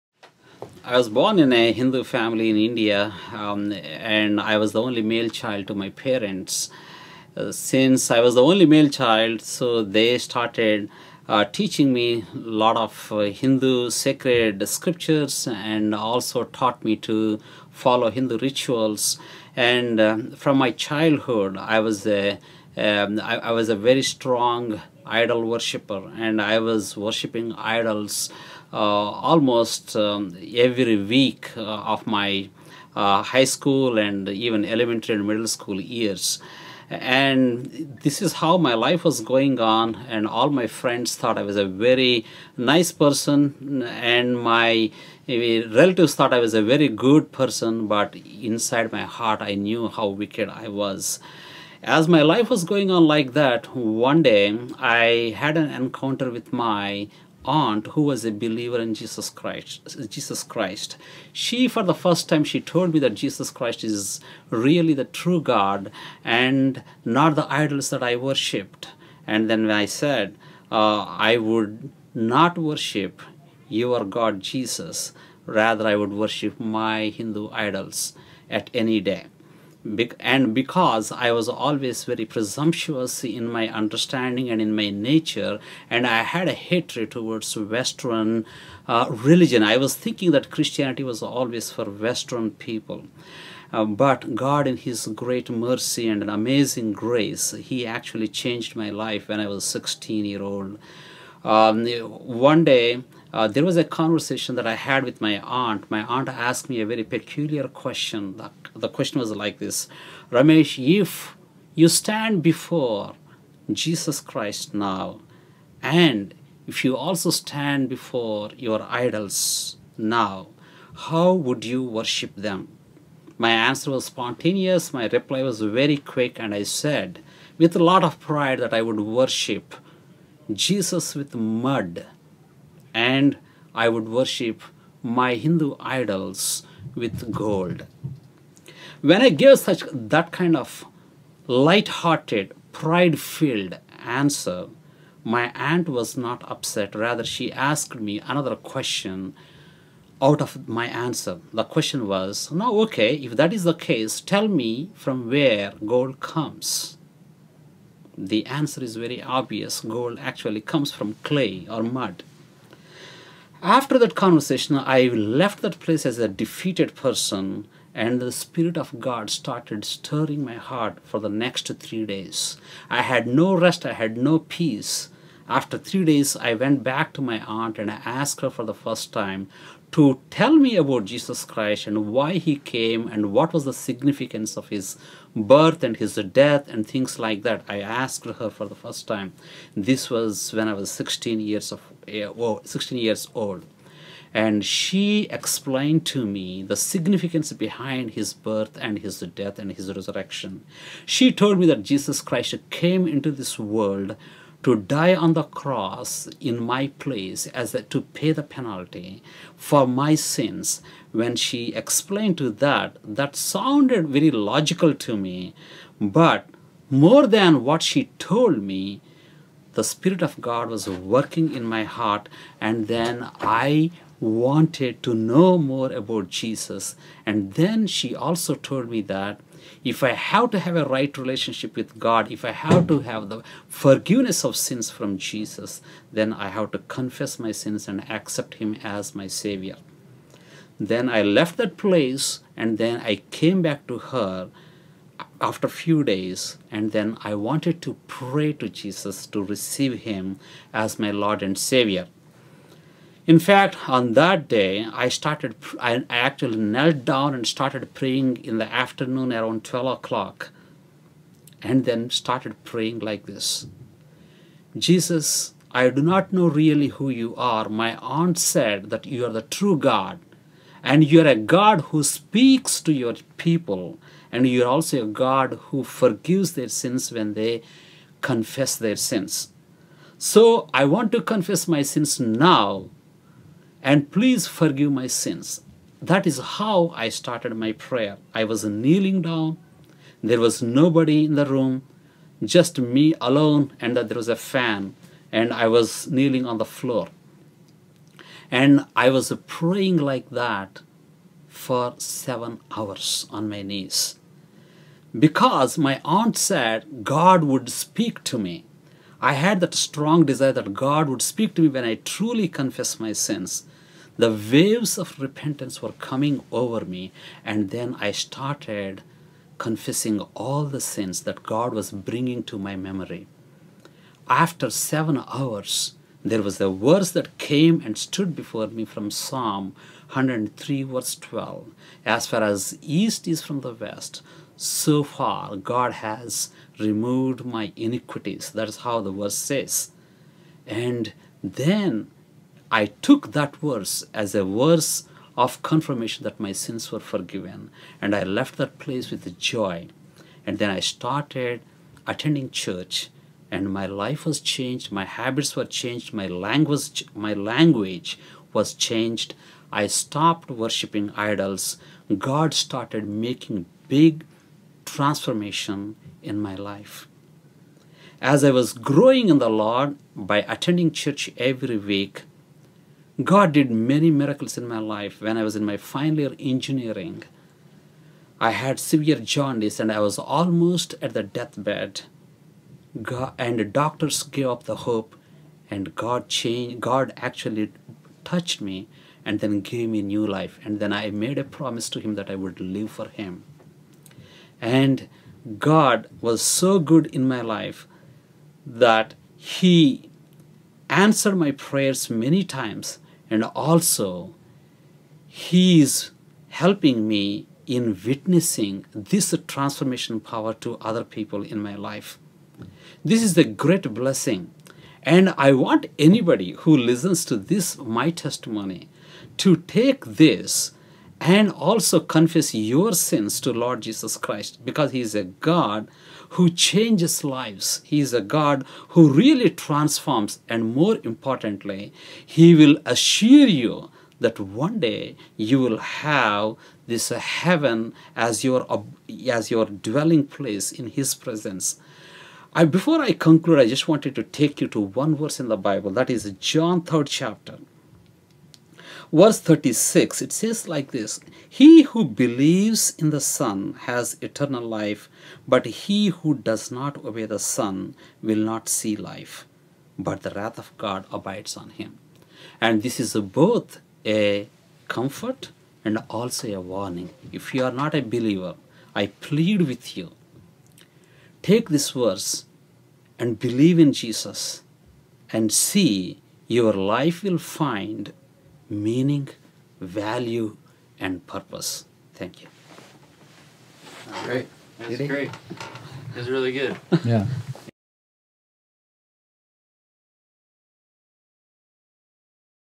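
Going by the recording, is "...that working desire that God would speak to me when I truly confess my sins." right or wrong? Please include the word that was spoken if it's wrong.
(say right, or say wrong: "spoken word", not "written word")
wrong: "strong", not "working".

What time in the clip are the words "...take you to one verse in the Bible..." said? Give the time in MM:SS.
07:24.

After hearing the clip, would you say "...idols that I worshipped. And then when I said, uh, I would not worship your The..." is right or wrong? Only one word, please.
wrong.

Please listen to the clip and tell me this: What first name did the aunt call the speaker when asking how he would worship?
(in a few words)
Ramesh.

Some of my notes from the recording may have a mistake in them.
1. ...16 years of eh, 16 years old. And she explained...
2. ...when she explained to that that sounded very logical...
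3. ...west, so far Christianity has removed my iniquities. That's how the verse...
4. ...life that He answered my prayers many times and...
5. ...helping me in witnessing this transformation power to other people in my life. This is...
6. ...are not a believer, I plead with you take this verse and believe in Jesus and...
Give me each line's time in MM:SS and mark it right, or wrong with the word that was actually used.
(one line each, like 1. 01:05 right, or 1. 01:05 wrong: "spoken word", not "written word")
1. 03:10 right
2. 03:31 right
3. 05:33 wrong: "God", not "Christianity"
4. 06:37 right
5. 06:46 right
6. 07:47 right.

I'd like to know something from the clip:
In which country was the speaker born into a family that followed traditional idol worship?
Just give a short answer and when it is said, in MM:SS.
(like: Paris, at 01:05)
India, at 00:02.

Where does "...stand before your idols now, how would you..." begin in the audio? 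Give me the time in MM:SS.
01:57.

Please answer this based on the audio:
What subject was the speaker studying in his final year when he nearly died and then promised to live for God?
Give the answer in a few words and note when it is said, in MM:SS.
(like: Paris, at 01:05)
Engineering, at 06:16.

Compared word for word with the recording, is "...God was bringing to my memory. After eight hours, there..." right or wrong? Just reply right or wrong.
wrong.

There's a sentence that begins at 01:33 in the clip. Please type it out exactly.
Uh, but God, in His great mercy and an amazing grace, He actually changed my life when I was 16 year old.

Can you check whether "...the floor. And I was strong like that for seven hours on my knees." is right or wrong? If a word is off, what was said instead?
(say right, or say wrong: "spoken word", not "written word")
wrong: "praying", not "strong".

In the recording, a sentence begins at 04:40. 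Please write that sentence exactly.
So I want to confess my sins now and please forgive my sins.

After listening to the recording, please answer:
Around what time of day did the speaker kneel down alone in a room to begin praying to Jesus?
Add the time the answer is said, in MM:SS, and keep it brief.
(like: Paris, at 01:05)
12 o'clock, at 04:19.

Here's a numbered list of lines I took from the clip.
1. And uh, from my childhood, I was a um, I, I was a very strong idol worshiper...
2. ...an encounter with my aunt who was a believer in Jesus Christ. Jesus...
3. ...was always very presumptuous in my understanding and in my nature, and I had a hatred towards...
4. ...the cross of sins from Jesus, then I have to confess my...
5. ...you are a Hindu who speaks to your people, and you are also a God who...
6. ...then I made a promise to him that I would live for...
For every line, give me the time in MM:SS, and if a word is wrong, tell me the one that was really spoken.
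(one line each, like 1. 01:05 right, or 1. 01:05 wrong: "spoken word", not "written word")
1. 00:19 right
2. 00:55 right
3. 01:21 right
4. 03:53 wrong: "forgiveness", not "cross"
5. 04:31 wrong: "God", not "Hindu"
6. 06:30 right.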